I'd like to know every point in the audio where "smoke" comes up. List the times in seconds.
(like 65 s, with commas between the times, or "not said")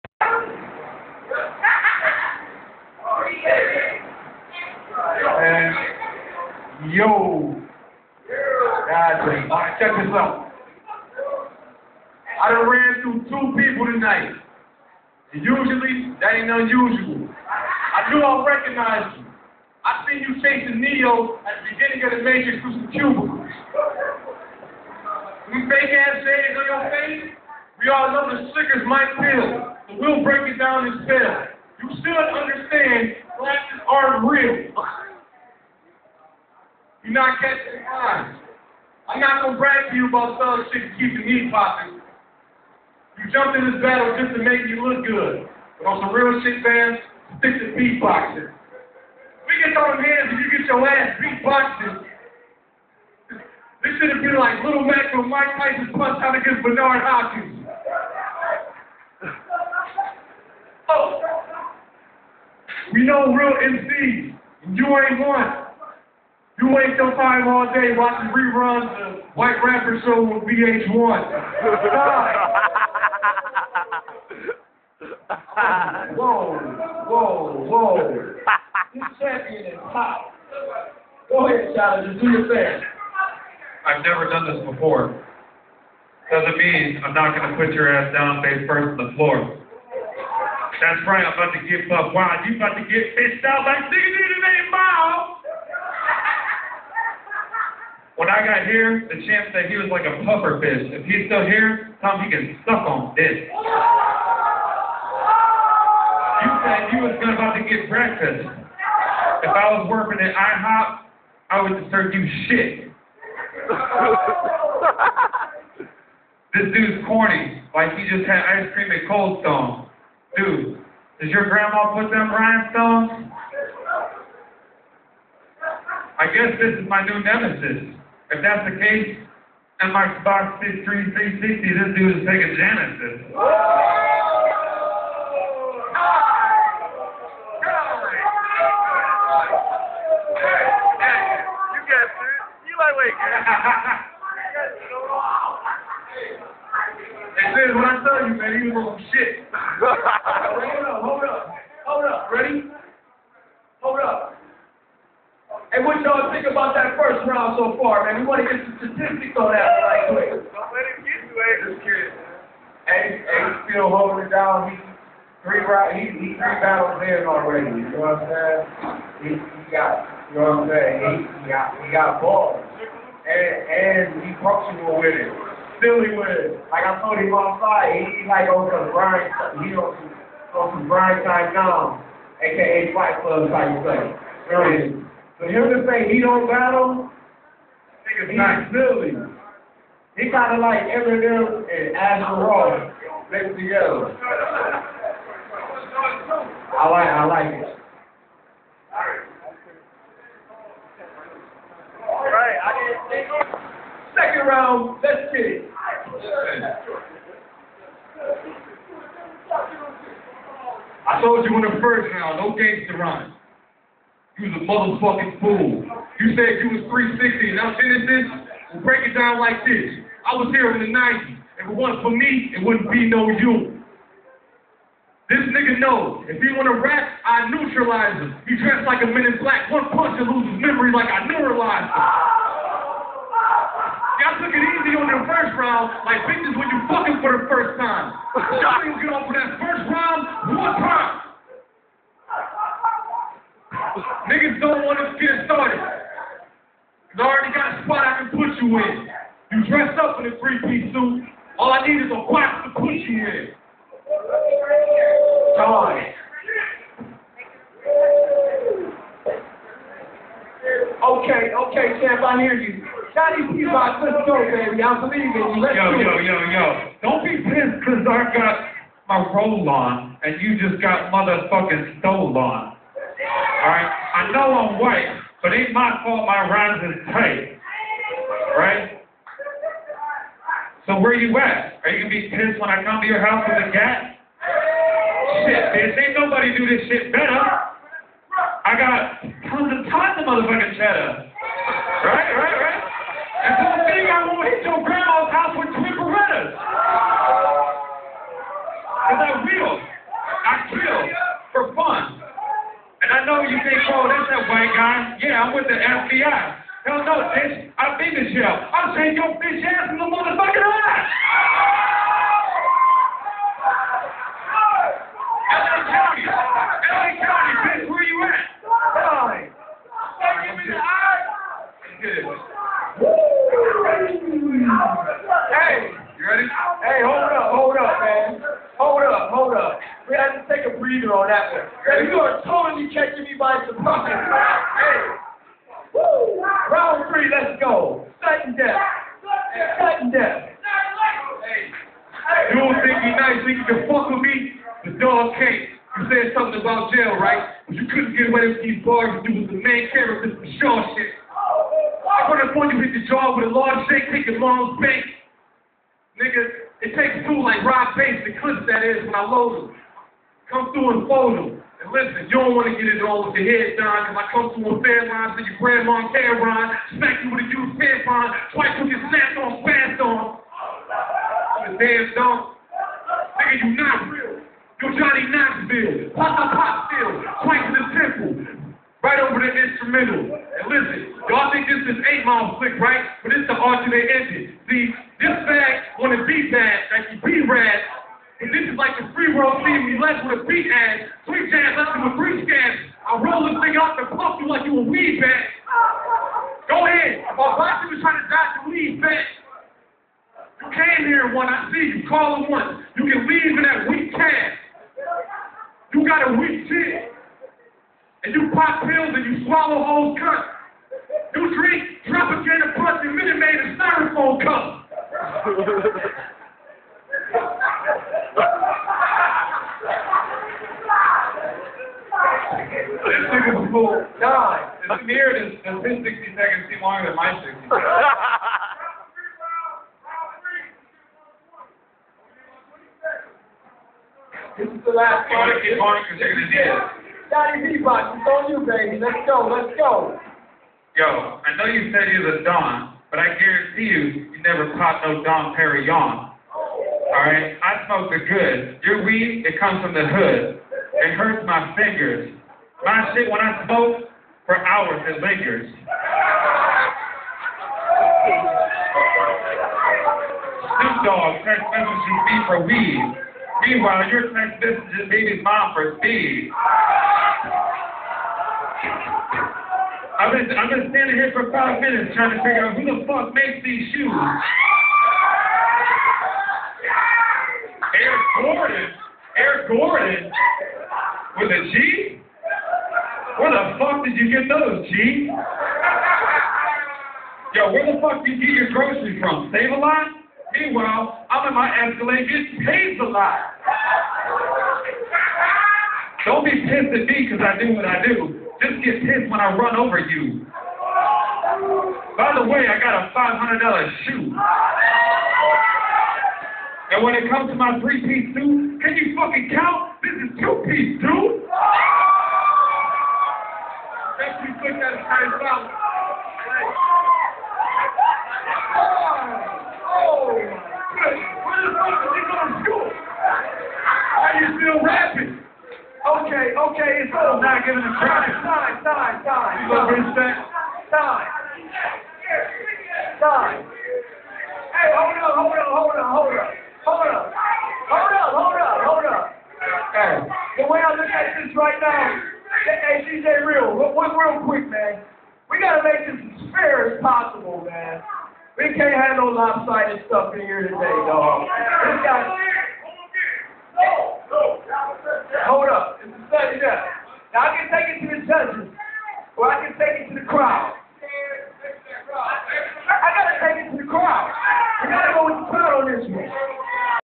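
447 s, 453 s.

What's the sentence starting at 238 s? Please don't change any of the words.
Y'all niggas get off of that first round one time.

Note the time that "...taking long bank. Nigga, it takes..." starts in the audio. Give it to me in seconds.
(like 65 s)
354 s.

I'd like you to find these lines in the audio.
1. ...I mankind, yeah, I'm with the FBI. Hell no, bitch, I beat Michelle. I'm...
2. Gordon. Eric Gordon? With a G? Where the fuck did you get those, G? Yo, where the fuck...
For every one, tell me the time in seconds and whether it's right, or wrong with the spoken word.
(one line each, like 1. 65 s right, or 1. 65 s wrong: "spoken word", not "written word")
1. 299 s right
2. 478 s right.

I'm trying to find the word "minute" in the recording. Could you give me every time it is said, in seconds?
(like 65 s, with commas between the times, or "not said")
413 s, 471 s.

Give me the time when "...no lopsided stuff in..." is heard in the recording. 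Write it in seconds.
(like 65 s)
549 s.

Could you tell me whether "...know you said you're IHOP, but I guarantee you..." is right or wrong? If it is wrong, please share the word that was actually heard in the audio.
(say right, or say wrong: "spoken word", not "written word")
wrong: "Don", not "IHOP".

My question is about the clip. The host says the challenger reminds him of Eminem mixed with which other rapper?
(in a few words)
Asher Roth.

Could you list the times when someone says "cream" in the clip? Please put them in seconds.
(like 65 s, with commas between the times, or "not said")
118 s.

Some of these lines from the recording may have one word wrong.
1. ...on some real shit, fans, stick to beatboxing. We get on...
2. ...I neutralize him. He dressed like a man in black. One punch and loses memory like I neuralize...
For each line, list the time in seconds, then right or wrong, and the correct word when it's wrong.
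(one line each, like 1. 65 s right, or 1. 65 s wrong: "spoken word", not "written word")
1. 45 s right
2. 227 s right.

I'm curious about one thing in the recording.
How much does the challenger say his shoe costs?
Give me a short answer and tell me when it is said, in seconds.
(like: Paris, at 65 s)
$500, at 503 s.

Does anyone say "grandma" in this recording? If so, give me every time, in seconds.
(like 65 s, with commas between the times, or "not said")
121 s, 294 s, 365 s.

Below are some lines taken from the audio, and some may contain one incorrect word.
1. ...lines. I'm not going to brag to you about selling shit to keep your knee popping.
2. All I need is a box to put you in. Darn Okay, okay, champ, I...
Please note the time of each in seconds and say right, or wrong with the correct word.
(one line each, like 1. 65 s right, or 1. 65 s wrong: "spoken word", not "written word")
1. 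37 s right
2. 251 s right.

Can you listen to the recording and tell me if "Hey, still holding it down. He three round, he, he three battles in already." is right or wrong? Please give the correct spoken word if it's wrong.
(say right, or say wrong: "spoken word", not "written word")
right.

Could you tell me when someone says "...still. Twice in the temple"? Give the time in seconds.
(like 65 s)
376 s.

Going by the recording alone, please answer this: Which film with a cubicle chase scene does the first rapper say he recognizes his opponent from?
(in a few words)
The Matrix.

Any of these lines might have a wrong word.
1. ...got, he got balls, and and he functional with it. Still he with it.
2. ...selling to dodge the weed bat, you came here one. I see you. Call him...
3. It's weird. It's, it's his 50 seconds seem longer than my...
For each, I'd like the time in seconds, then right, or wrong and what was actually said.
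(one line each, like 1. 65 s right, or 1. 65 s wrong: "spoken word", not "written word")
1. 171 s right
2. 398 s wrong: "trying", not "selling"
3. 424 s wrong: "60", not "50".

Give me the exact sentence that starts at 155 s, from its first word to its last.
Hey, what y'all think about that first round so far, man?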